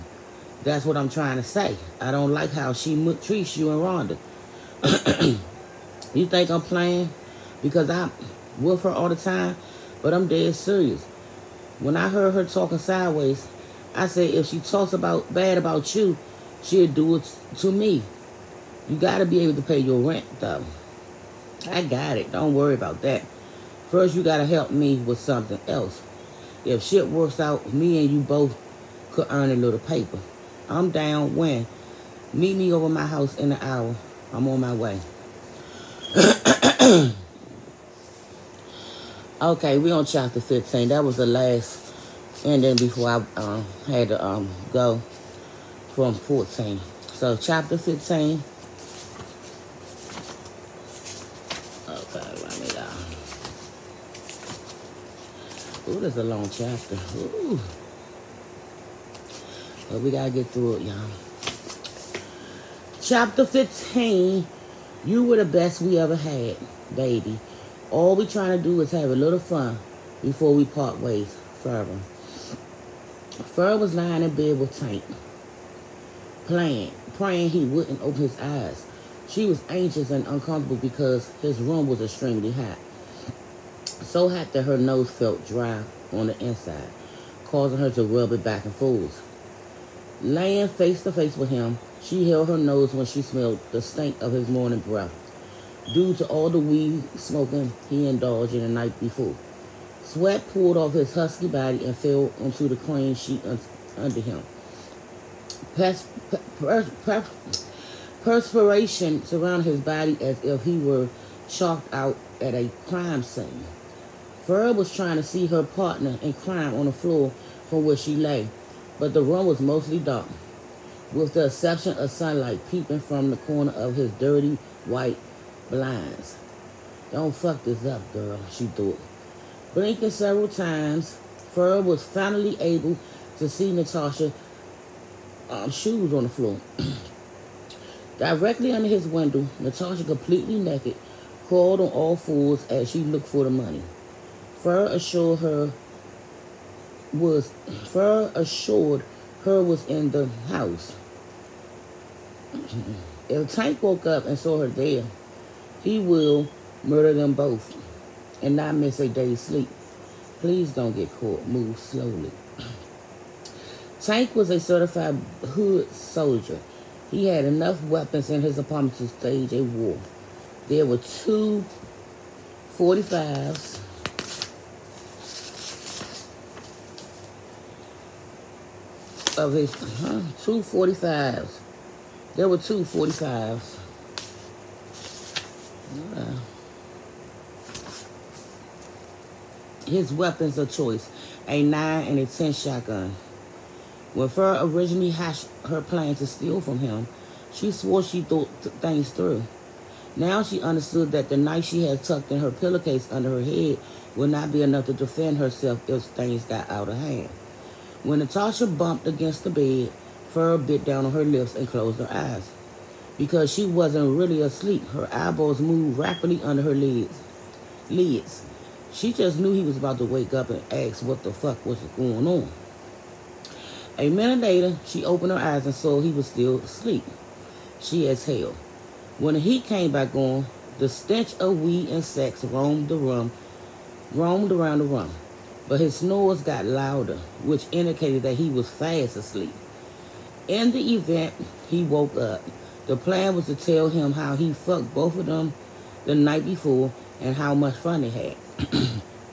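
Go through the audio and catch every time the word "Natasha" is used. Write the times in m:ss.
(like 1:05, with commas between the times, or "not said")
2:13, 2:19, 3:28.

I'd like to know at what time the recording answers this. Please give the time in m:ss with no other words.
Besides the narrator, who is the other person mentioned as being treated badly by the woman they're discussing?
0:04.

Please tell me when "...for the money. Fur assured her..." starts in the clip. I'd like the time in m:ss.
2:23.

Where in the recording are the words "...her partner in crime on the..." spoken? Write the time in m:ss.
1:55.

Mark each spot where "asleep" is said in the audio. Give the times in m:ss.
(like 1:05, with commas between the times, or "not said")
3:34, 3:46, 3:59.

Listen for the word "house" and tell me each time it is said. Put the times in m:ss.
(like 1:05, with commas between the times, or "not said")
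0:33, 2:30.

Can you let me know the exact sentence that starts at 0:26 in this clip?
If shit works out, me and you both could earn a little paper.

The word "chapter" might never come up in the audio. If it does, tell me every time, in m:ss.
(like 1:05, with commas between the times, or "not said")
0:40, 0:47, 0:56, 1:03.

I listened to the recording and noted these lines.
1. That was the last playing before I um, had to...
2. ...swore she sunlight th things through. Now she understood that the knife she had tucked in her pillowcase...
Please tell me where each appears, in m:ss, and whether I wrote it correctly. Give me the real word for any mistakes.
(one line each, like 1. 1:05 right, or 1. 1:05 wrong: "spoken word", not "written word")
1. 0:40 wrong: "ending", not "playing"
2. 3:17 wrong: "thought", not "sunlight".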